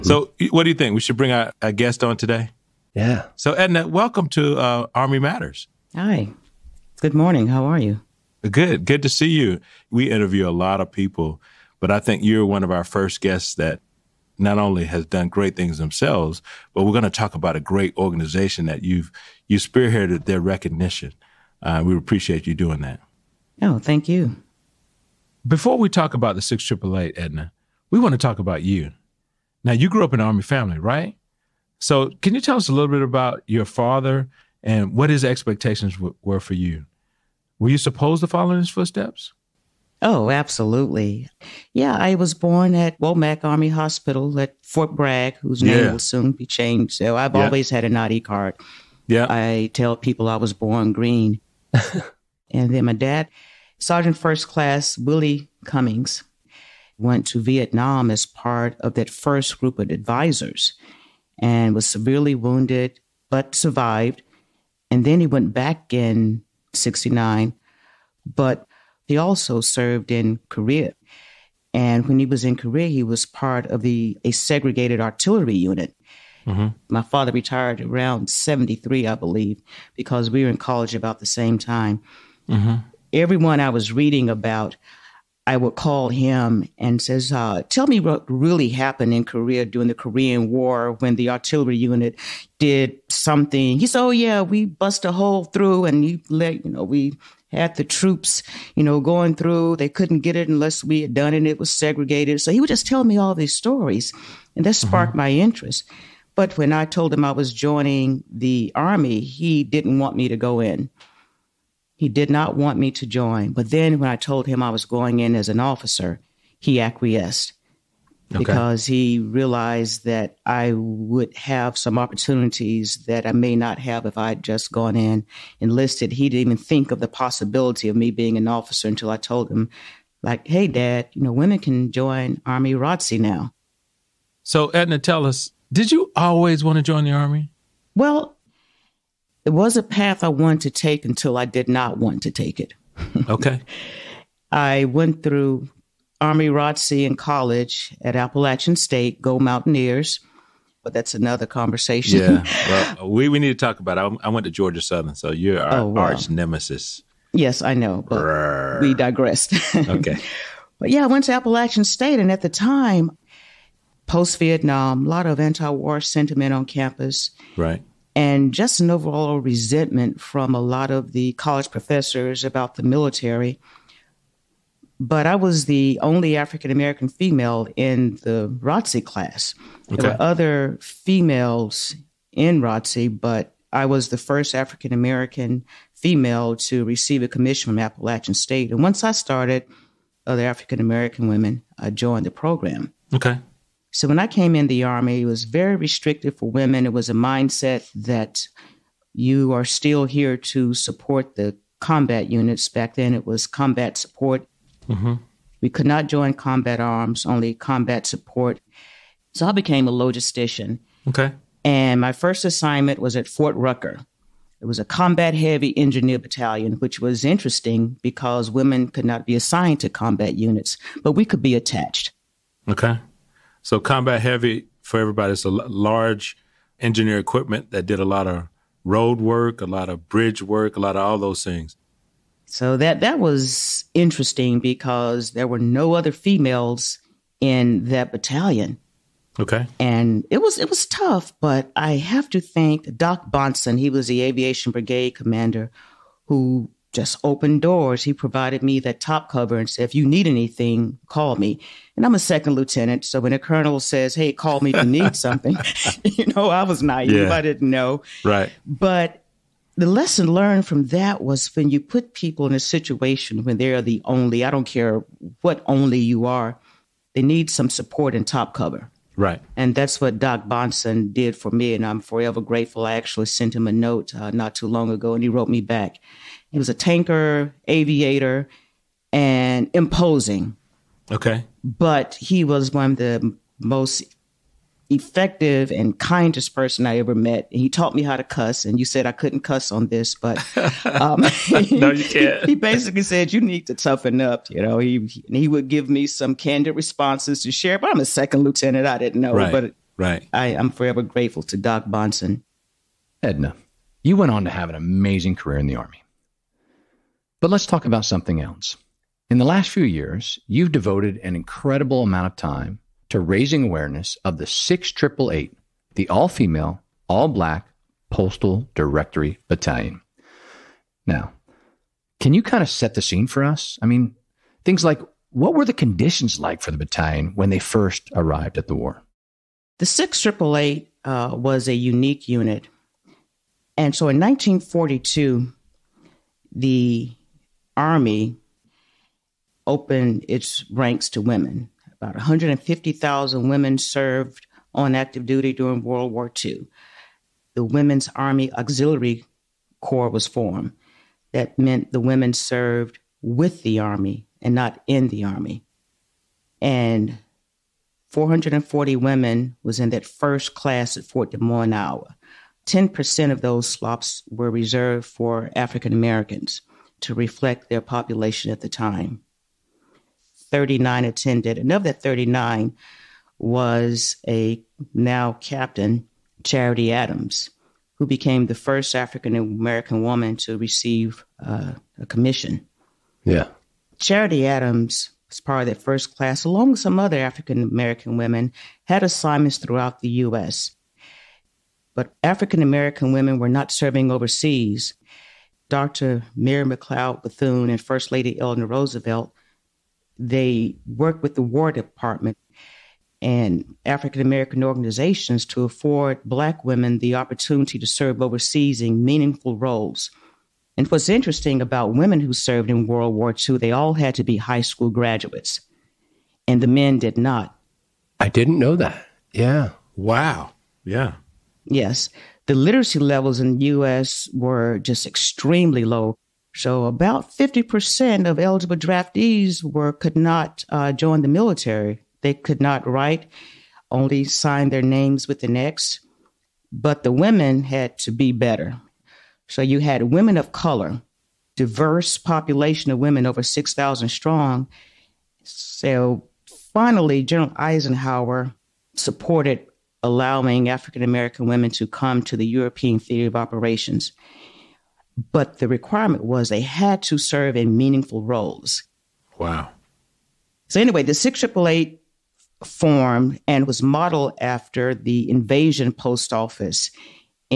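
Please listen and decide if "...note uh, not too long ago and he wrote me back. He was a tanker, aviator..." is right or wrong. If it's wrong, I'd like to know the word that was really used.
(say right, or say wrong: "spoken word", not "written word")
right.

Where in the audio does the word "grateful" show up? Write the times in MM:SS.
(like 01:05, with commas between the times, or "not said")
04:32, 05:01.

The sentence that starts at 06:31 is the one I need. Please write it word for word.
But African American women were not serving overseas.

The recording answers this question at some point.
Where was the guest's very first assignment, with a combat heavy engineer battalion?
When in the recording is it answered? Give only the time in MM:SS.
03:33.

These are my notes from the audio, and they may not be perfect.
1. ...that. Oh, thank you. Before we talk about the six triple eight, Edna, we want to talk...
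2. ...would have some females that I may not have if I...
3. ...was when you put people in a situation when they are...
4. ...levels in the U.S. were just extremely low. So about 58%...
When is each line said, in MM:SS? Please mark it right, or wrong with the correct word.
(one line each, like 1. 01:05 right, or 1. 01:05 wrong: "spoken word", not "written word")
1. 00:22 right
2. 02:00 wrong: "opportunities", not "females"
3. 04:21 right
4. 07:02 wrong: "50", not "58".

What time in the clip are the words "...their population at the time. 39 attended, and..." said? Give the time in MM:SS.
06:07.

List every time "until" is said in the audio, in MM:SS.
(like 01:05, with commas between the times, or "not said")
02:08, 02:21.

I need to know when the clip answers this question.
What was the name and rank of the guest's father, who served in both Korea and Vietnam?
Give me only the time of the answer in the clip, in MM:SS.
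00:53.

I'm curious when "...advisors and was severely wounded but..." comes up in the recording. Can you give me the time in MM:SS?
00:59.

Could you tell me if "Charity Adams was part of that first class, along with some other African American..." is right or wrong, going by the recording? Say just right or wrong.
right.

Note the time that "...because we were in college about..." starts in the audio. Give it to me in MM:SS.
01:19.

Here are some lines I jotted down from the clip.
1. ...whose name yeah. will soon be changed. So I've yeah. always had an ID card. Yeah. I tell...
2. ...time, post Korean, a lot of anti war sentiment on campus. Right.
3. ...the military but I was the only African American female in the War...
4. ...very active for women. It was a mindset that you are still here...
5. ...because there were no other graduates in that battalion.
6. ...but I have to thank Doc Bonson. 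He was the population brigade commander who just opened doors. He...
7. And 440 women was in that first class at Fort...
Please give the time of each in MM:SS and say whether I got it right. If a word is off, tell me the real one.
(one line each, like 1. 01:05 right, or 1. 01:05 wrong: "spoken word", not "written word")
1. 00:45 right
2. 02:42 wrong: "Vietnam", not "Korean"
3. 02:52 wrong: "ROTC", not "War"
4. 03:15 wrong: "restrictive", not "active"
5. 03:54 wrong: "females", not "graduates"
6. 04:01 wrong: "aviation", not "population"
7. 05:56 right.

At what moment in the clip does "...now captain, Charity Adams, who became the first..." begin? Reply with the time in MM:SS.
06:14.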